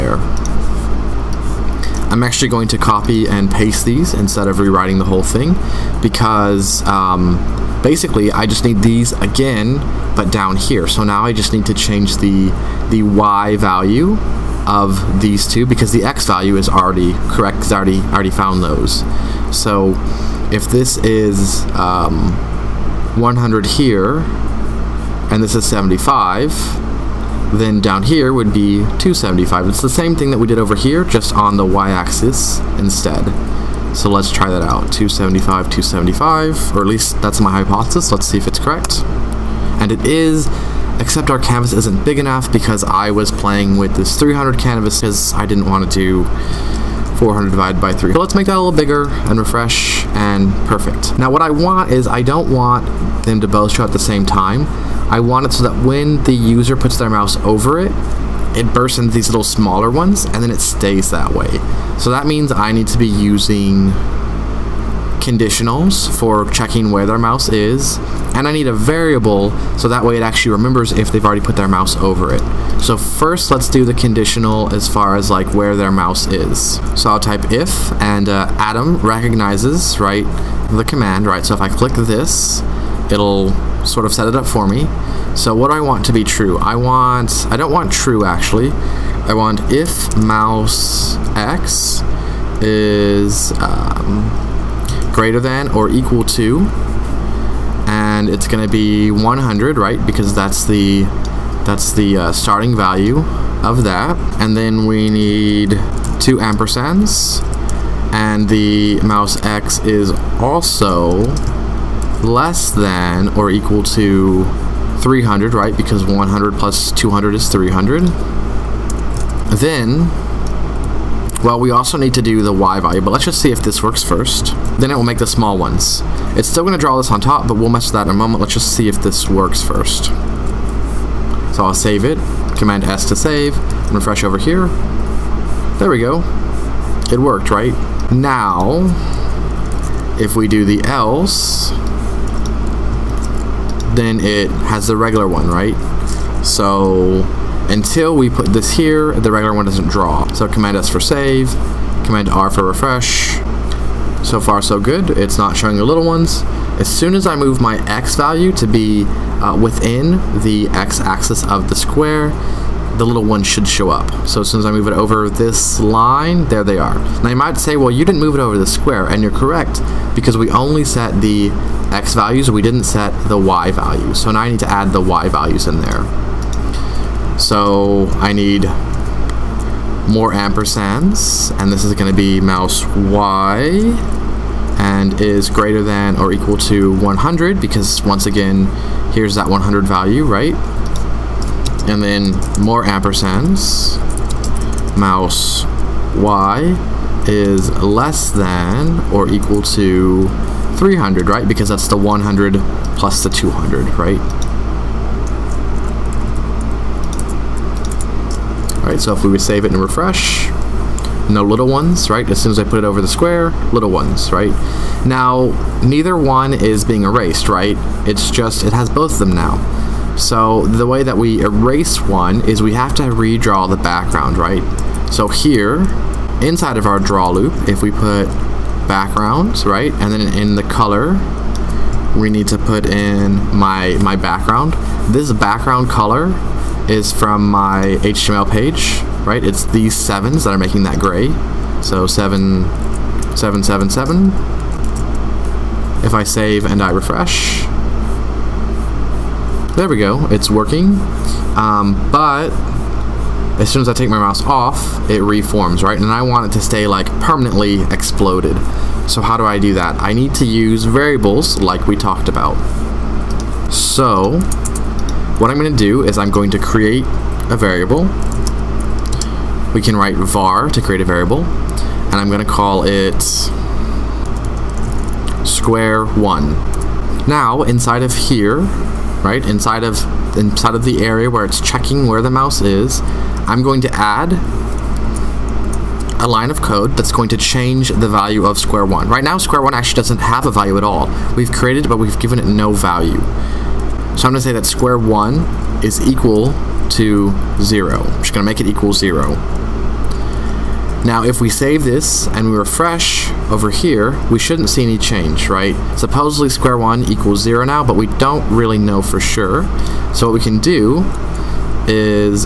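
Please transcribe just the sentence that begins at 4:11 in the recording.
Um, but as soon as I take my mouse off, it reforms, right?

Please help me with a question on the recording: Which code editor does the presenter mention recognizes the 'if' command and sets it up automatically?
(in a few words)
Atom.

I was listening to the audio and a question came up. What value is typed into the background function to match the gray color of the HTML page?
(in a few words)
7777.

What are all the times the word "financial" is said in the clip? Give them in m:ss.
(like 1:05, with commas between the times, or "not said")
not said.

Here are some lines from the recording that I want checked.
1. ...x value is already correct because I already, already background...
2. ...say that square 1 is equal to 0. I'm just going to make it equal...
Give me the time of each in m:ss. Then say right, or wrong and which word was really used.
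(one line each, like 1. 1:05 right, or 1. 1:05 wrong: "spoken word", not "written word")
1. 0:16 wrong: "found", not "background"
2. 4:54 right.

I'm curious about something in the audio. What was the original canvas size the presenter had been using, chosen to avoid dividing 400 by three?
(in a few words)
300.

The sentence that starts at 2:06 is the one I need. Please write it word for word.
It's still going to draw this on top, but we'll mess with that in a moment.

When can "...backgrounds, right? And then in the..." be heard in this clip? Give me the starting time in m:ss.
3:48.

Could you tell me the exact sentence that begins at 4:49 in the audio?
Right now, square one actually doesn't have a value at all.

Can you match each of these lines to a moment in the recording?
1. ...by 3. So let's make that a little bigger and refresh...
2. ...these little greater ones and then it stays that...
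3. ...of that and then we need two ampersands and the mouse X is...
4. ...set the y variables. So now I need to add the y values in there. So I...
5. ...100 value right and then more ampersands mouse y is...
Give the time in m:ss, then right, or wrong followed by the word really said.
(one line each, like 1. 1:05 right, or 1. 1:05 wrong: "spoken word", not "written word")
1. 0:47 right
2. 0:59 wrong: "smaller", not "greater"
3. 1:43 right
4. 2:52 wrong: "values", not "variables"
5. 3:09 right.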